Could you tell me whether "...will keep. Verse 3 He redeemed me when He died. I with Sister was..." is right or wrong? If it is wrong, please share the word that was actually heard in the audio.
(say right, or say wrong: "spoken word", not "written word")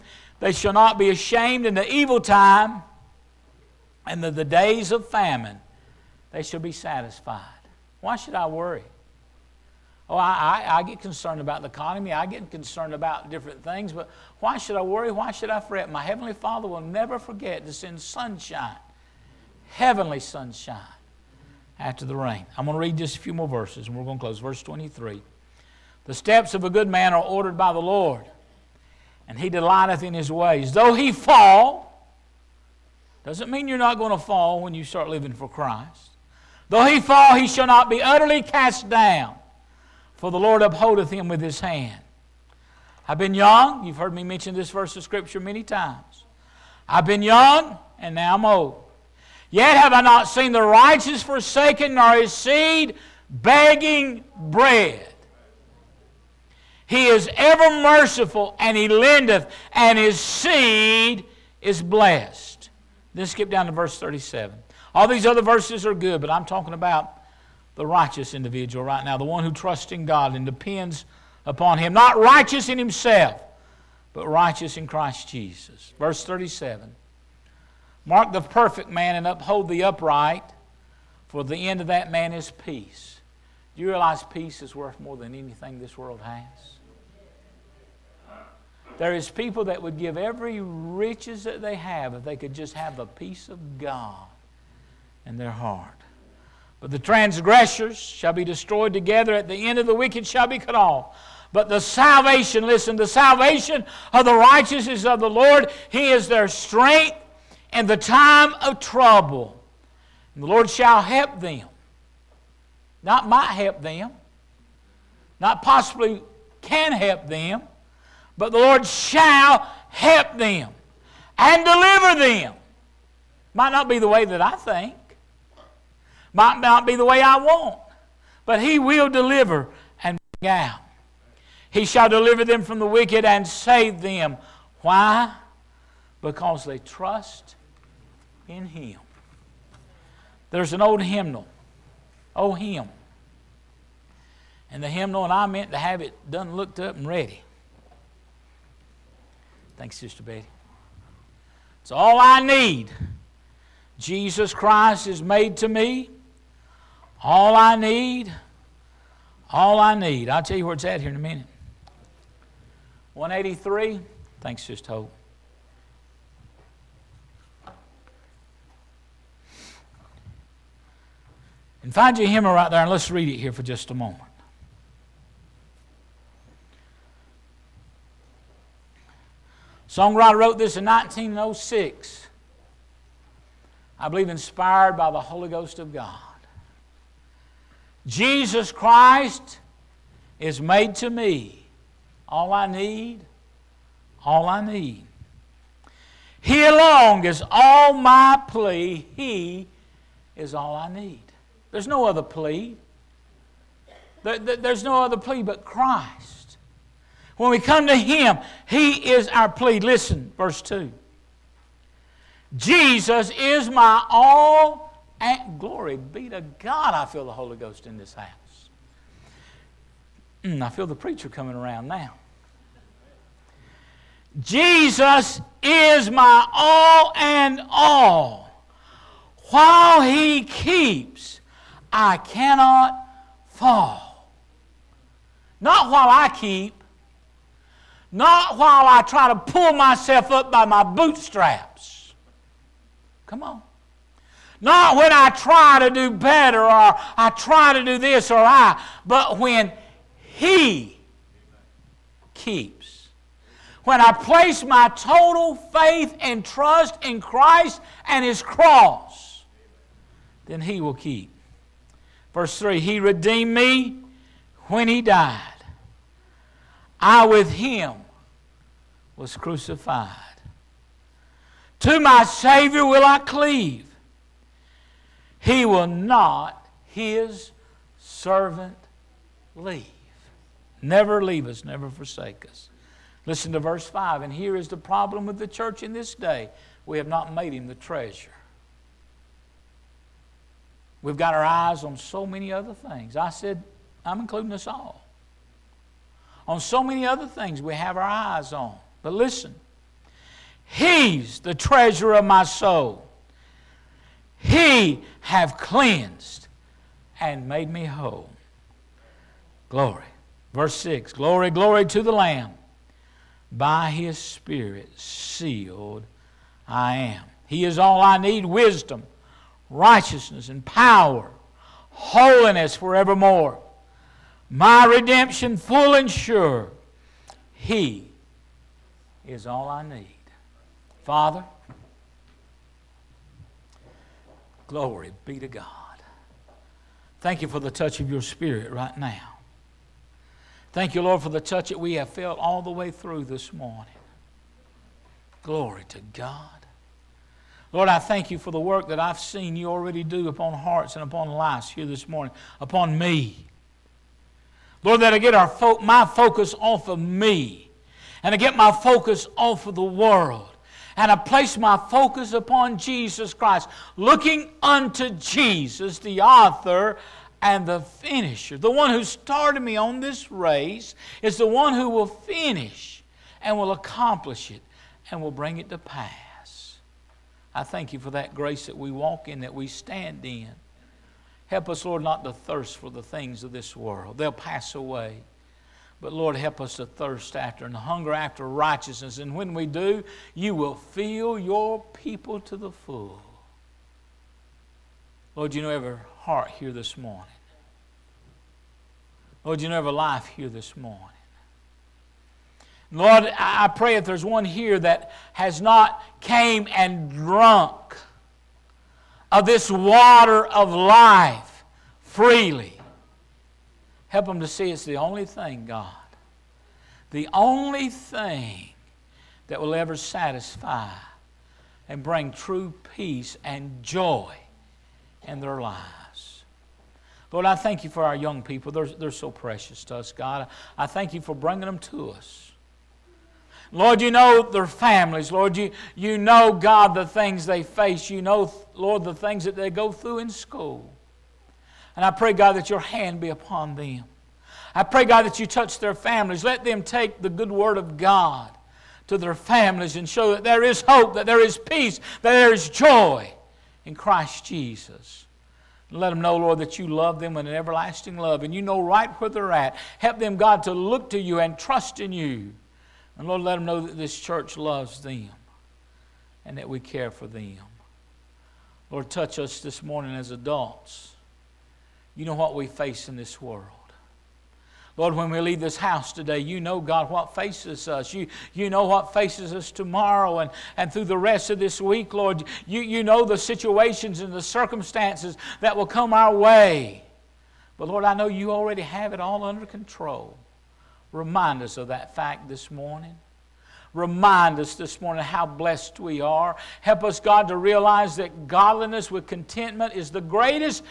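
wrong: "Him", not "Sister".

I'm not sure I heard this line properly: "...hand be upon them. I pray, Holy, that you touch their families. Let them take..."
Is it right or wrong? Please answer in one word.
wrong.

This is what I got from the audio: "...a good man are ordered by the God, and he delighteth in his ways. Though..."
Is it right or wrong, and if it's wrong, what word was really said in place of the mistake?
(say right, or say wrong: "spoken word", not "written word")
wrong: "Lord", not "God".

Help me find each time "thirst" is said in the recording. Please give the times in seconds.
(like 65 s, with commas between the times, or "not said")
382 s, 386 s.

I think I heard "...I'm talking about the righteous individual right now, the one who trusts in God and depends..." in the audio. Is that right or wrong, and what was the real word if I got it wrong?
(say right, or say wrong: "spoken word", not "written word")
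right.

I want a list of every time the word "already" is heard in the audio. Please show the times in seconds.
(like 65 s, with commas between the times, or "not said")
349 s, 488 s.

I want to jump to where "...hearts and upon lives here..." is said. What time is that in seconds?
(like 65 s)
350 s.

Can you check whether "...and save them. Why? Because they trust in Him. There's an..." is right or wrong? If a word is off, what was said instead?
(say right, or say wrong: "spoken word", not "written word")
right.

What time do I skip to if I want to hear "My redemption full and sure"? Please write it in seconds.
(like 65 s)
324 s.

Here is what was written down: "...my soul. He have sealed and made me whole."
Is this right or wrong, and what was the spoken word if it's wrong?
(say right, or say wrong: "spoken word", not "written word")
wrong: "cleansed", not "sealed".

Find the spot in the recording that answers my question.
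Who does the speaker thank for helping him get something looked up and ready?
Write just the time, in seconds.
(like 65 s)
149 s.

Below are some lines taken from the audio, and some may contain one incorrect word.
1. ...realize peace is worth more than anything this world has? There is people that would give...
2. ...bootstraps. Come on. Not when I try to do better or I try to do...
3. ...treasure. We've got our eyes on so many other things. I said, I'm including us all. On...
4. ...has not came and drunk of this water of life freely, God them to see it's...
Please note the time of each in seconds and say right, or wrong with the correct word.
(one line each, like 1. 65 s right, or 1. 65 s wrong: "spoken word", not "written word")
1. 83 s right
2. 240 s right
3. 287 s right
4. 405 s wrong: "Help", not "God".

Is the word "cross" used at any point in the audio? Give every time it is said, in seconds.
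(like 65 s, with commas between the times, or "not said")
258 s.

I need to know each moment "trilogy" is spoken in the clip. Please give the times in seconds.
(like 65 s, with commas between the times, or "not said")
not said.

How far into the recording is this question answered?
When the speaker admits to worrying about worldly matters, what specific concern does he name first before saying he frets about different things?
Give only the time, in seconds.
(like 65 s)
11 s.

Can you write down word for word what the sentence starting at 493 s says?
Remind us this morning how blessed we are.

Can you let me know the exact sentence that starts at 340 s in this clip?
Thank you, Lord, for the touch that we have felt all the way through this morning.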